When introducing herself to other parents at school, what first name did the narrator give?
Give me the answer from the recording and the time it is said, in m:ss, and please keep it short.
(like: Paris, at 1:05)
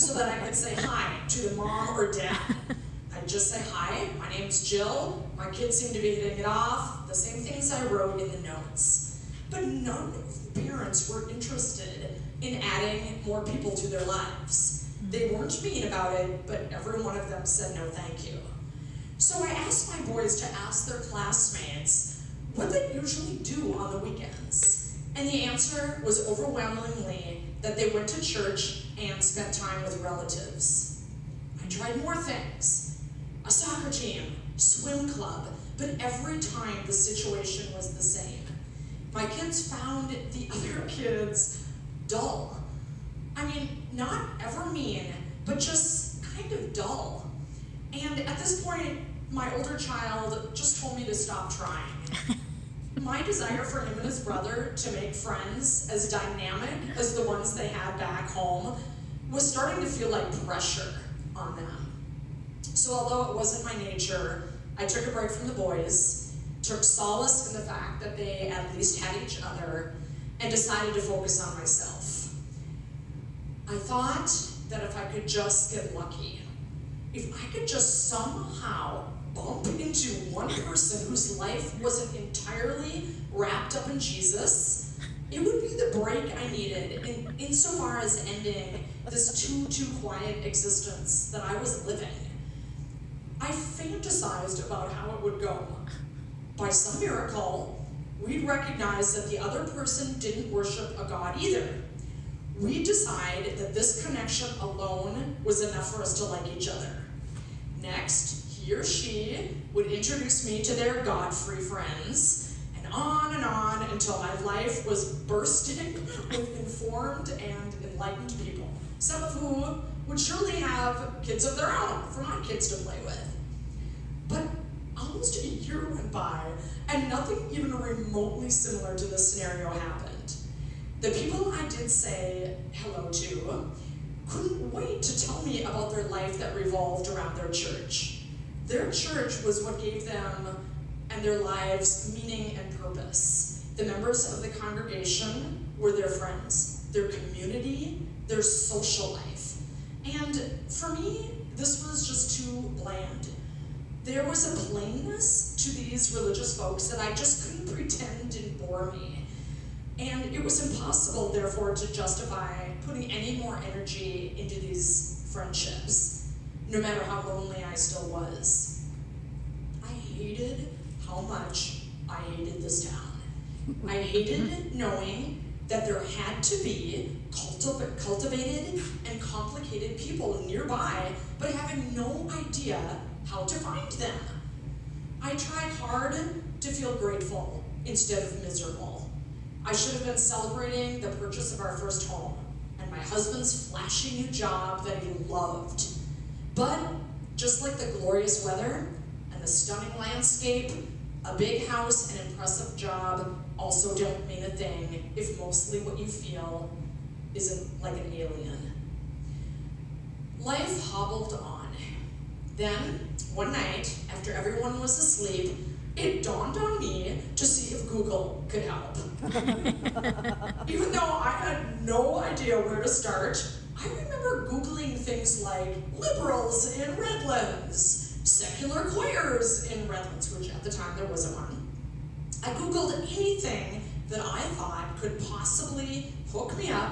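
Jill, at 0:04.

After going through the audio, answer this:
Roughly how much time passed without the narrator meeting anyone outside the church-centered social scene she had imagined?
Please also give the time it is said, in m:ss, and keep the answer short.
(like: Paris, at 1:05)
almost a year, at 2:04.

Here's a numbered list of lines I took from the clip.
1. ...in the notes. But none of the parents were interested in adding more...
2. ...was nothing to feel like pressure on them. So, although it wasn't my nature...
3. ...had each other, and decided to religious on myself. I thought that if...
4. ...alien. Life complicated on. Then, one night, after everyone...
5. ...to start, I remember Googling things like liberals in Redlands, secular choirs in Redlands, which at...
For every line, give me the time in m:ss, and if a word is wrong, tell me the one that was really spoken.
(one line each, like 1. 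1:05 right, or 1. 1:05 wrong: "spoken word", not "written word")
1. 0:08 right
2. 0:59 wrong: "starting", not "nothing"
3. 1:09 wrong: "focus", not "religious"
4. 3:28 wrong: "hobbled", not "complicated"
5. 3:42 right.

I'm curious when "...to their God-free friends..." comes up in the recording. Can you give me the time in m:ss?
1:50.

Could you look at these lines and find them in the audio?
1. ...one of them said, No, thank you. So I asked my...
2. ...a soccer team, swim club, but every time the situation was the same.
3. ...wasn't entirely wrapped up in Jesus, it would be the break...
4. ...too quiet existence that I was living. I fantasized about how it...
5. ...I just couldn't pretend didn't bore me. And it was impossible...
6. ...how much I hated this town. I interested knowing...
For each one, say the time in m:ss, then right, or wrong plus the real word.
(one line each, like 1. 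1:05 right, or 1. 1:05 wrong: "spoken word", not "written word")
1. 0:17 right
2. 0:33 right
3. 1:21 right
4. 1:29 right
5. 2:36 right
6. 2:51 wrong: "hated", not "interested".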